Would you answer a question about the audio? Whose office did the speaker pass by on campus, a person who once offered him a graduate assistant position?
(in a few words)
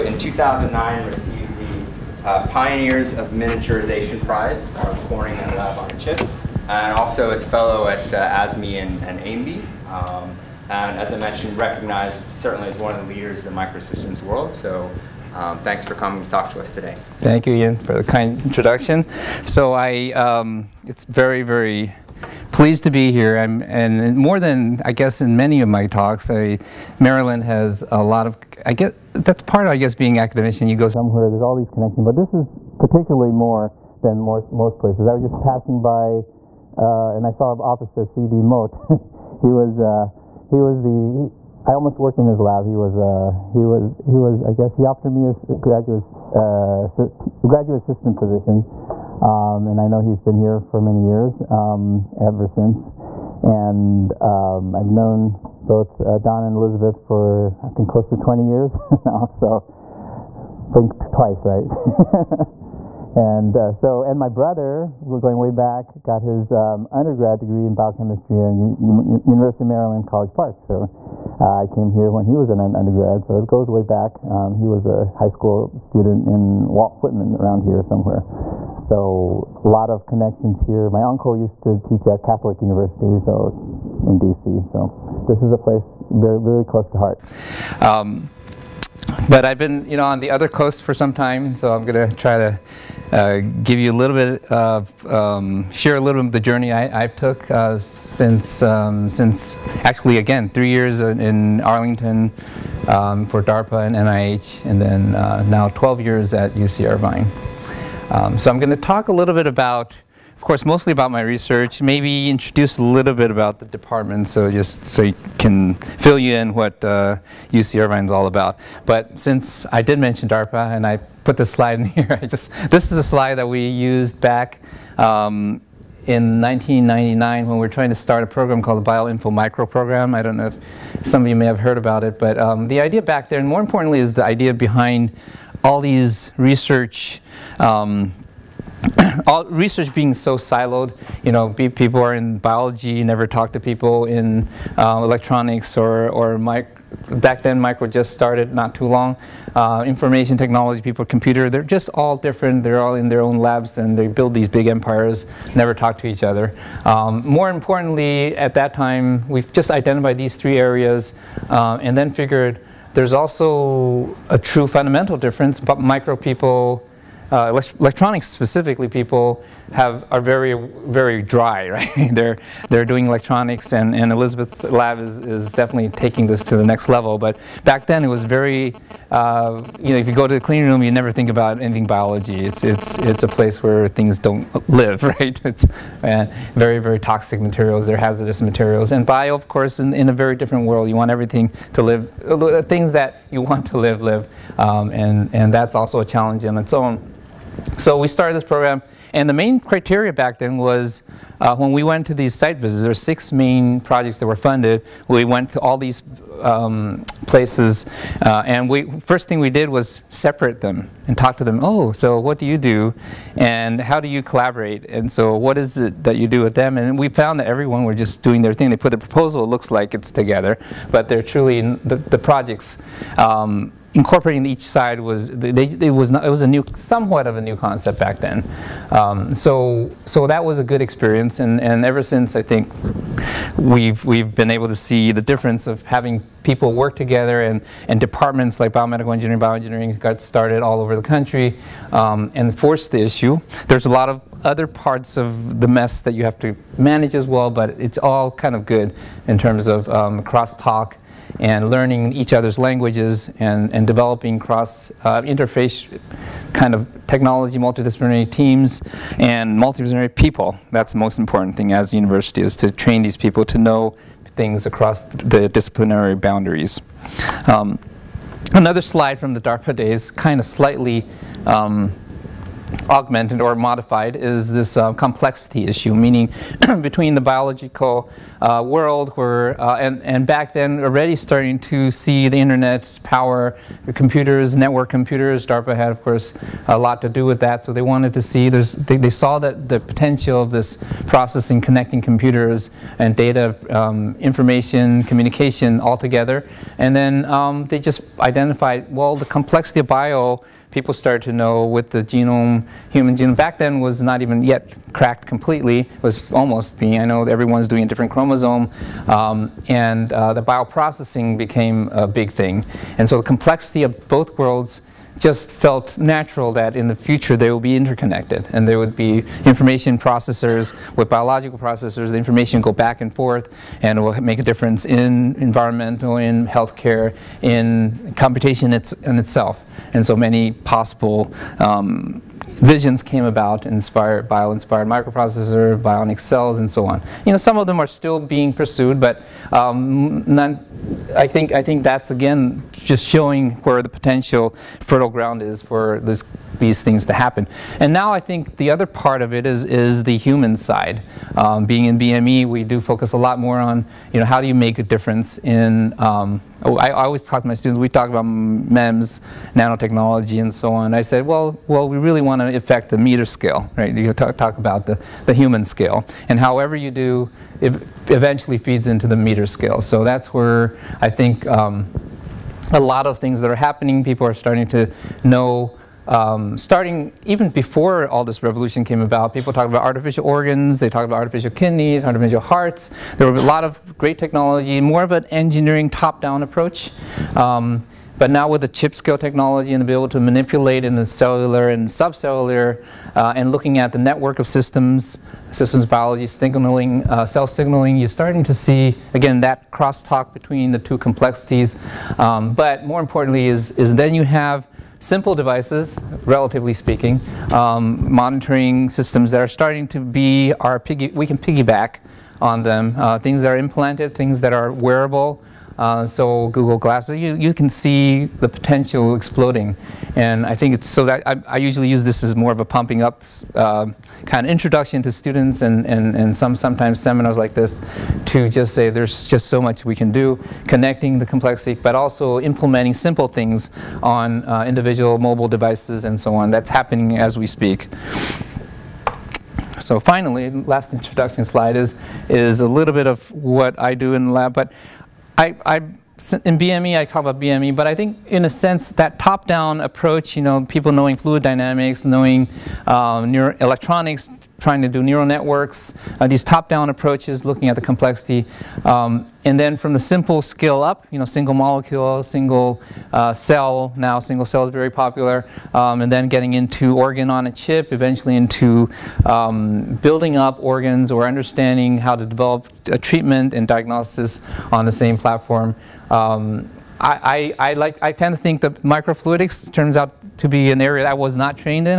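C.D. Mote.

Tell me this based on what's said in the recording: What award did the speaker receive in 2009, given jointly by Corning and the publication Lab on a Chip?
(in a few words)
Pioneers of Miniaturization Prize.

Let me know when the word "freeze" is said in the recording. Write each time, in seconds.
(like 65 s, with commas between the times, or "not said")
not said.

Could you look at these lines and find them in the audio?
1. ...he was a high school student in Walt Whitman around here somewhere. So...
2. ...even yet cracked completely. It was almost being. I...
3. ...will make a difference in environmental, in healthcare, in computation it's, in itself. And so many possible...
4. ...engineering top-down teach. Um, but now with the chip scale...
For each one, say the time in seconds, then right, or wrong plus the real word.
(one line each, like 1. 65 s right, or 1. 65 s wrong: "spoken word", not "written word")
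1. 74 s right
2. 304 s right
3. 324 s right
4. 385 s wrong: "approach", not "teach".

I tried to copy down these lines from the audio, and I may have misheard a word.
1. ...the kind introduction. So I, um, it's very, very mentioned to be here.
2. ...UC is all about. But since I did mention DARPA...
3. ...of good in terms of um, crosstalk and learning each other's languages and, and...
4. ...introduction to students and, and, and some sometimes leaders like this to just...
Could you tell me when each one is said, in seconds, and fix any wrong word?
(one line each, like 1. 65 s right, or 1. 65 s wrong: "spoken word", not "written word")
1. 17 s wrong: "pleased", not "mentioned"
2. 117 s right
3. 248 s right
4. 424 s wrong: "seminars", not "leaders".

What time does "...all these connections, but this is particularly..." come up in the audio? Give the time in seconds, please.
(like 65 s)
31 s.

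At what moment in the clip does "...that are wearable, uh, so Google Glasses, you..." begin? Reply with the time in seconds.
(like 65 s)
414 s.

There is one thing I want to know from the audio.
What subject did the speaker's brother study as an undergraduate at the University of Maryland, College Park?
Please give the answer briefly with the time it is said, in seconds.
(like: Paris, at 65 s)
biochemistry, at 67 s.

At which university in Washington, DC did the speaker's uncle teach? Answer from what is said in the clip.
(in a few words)
Catholic University.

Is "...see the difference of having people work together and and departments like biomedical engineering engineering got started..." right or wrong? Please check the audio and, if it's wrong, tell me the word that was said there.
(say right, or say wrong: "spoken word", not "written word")
wrong: "bioengineering", not "engineering".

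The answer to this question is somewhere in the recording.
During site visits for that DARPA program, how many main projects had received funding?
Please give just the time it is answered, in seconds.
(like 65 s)
202 s.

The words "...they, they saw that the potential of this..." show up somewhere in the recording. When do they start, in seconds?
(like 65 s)
288 s.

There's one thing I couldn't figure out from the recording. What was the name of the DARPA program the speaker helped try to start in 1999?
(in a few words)
BioInfo Micro Program.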